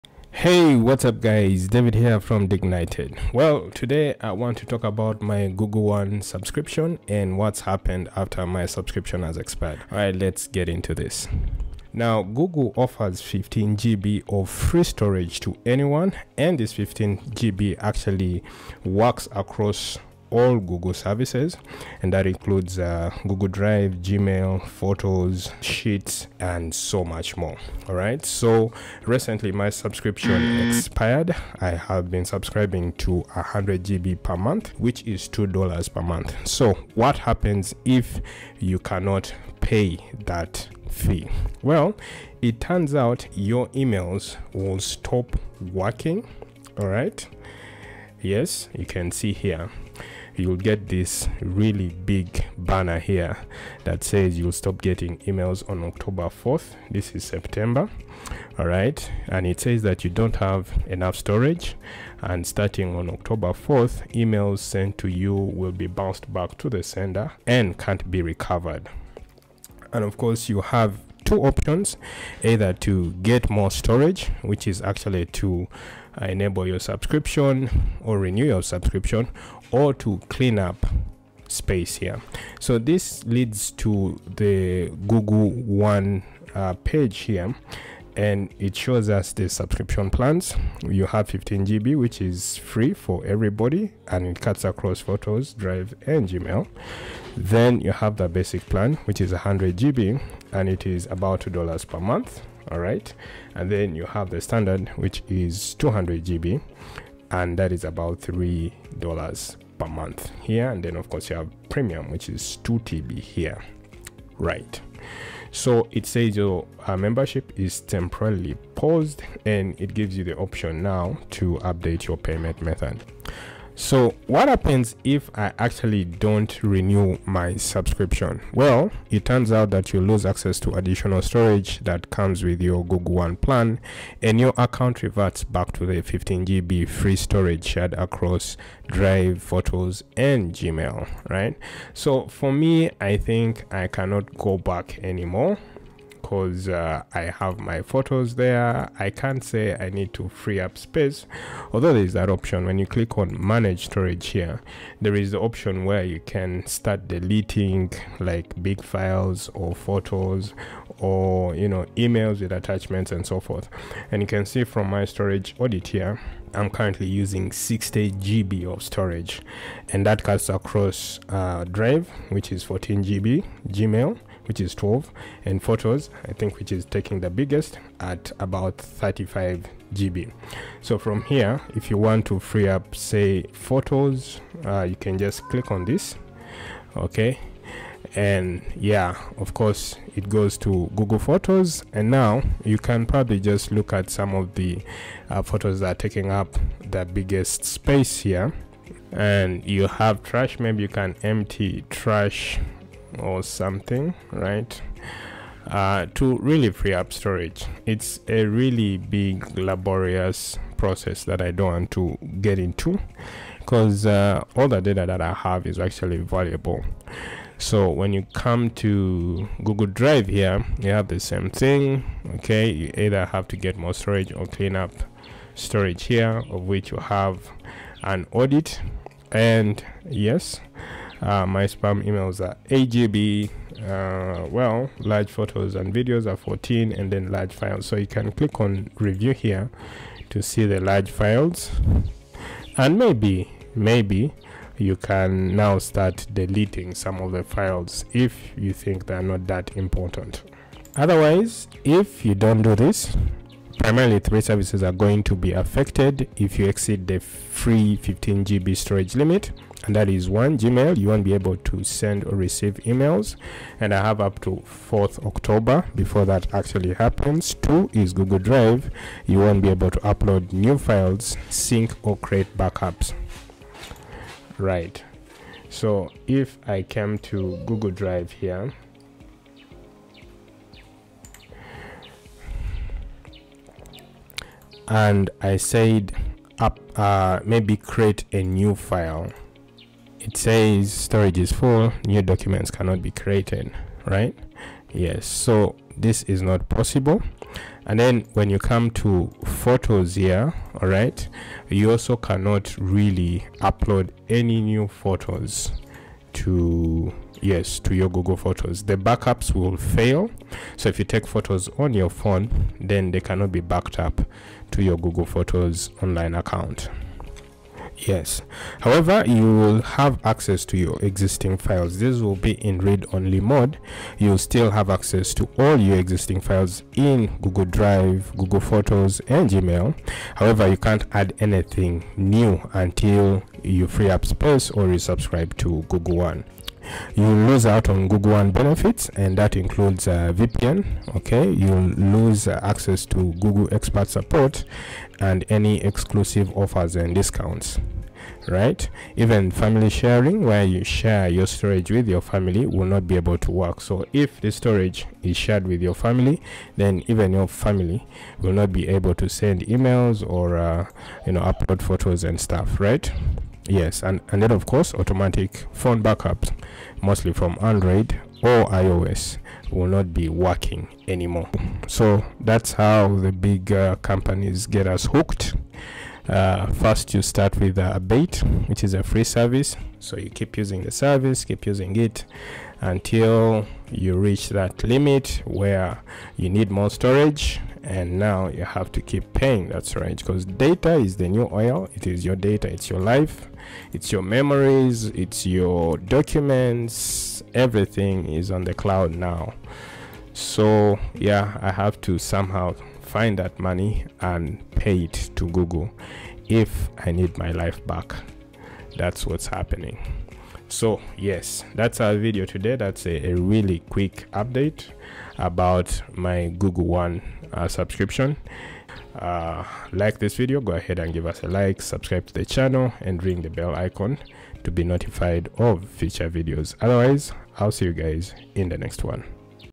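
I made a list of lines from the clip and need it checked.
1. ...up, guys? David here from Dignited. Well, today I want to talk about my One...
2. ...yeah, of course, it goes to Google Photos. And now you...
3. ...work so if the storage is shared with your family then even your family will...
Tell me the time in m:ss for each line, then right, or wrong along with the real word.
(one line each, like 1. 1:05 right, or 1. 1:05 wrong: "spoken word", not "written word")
1. 0:01 wrong: "Google", not "One"
2. 3:08 right
3. 5:53 right.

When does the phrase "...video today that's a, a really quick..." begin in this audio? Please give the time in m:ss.
6:52.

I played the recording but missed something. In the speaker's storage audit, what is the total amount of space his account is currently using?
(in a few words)
60 GB.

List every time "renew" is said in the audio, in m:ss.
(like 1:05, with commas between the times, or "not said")
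1:18, 2:06.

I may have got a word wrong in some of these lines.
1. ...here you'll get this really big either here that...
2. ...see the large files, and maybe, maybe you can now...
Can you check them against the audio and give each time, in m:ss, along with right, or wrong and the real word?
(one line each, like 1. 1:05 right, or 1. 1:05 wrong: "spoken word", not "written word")
1. 0:49 wrong: "banner", not "either"
2. 4:00 right.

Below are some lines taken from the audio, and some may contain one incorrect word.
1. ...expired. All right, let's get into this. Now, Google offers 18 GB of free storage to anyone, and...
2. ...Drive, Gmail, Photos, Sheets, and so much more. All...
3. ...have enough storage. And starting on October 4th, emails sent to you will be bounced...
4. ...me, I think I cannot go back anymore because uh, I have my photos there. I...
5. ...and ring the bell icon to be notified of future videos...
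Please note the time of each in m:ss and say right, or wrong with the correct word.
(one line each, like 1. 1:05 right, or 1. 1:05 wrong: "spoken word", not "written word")
1. 0:09 wrong: "15", not "18"
2. 0:23 right
3. 1:00 right
4. 2:22 right
5. 7:03 right.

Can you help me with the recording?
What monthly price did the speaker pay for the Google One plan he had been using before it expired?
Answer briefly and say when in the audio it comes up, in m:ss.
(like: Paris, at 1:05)
$2 per month, at 0:35.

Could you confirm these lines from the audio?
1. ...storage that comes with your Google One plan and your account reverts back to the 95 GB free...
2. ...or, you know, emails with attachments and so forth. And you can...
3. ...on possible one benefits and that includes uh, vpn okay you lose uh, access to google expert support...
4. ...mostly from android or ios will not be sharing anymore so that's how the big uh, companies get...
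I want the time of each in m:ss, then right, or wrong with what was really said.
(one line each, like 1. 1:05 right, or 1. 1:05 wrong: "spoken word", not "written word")
1. 2:11 wrong: "15", not "95"
2. 2:40 right
3. 5:37 wrong: "google", not "possible"
4. 6:07 wrong: "working", not "sharing".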